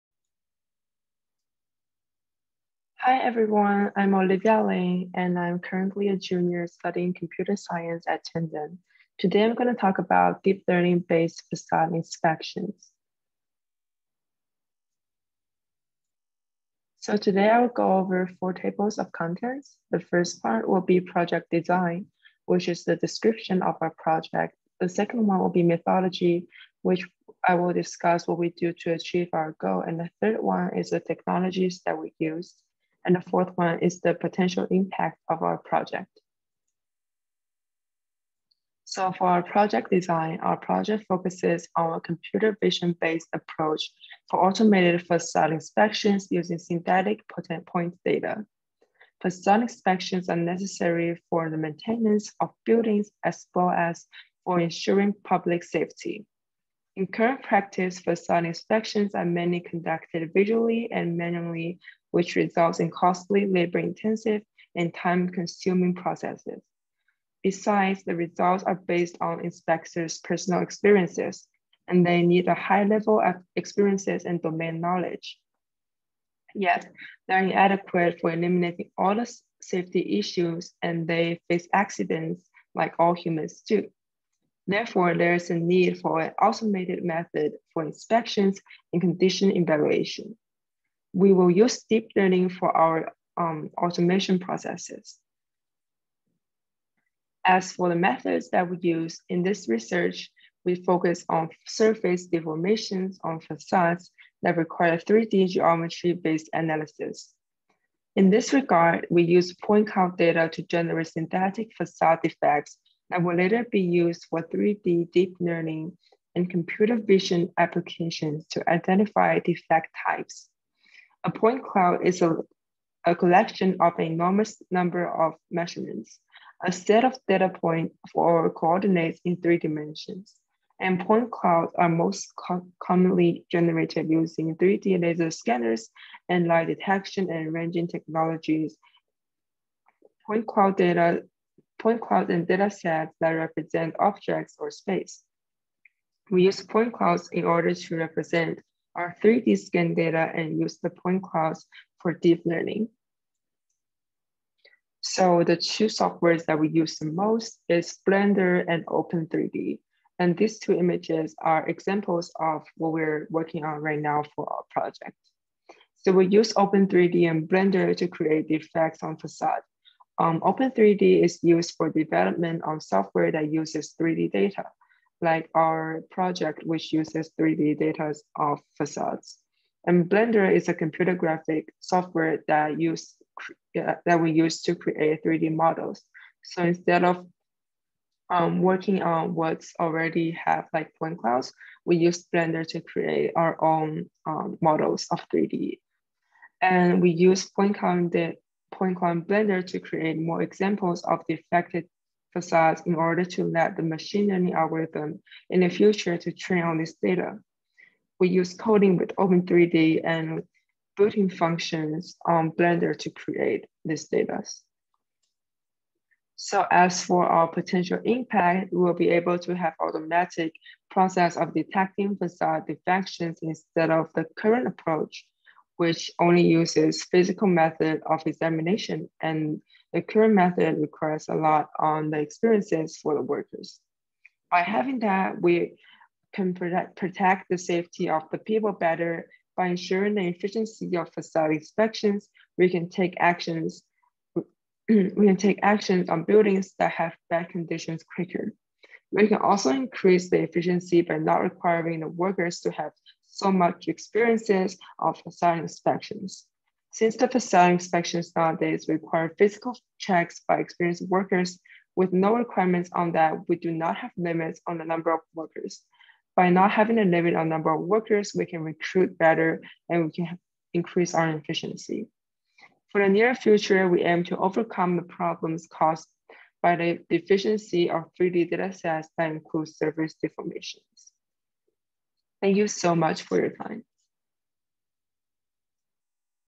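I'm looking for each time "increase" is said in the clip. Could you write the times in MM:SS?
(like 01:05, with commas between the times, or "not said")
04:09, 04:30.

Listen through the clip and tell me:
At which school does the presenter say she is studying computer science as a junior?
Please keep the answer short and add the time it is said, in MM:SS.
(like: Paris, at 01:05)
Tandon, at 00:08.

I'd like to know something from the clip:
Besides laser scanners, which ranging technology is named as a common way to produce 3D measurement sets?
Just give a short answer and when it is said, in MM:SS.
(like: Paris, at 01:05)
Light detection and ranging, at 02:16.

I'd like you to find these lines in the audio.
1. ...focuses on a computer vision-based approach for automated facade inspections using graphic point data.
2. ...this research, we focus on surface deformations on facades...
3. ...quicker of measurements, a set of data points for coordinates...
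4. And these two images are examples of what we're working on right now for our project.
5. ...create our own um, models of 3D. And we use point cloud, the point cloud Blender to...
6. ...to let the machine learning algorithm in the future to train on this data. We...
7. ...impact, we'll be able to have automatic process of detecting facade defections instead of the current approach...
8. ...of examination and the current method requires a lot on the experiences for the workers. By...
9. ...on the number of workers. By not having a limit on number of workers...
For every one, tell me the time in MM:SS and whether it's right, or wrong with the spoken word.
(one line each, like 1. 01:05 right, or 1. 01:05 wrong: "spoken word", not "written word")
1. 00:41 wrong: "synthetic", not "graphic"
2. 01:39 right
3. 02:04 wrong: "number", not "quicker"
4. 02:40 right
5. 03:12 right
6. 03:23 right
7. 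03:38 right
8. 03:48 right
9. 04:24 right.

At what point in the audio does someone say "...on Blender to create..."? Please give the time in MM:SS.
03:32.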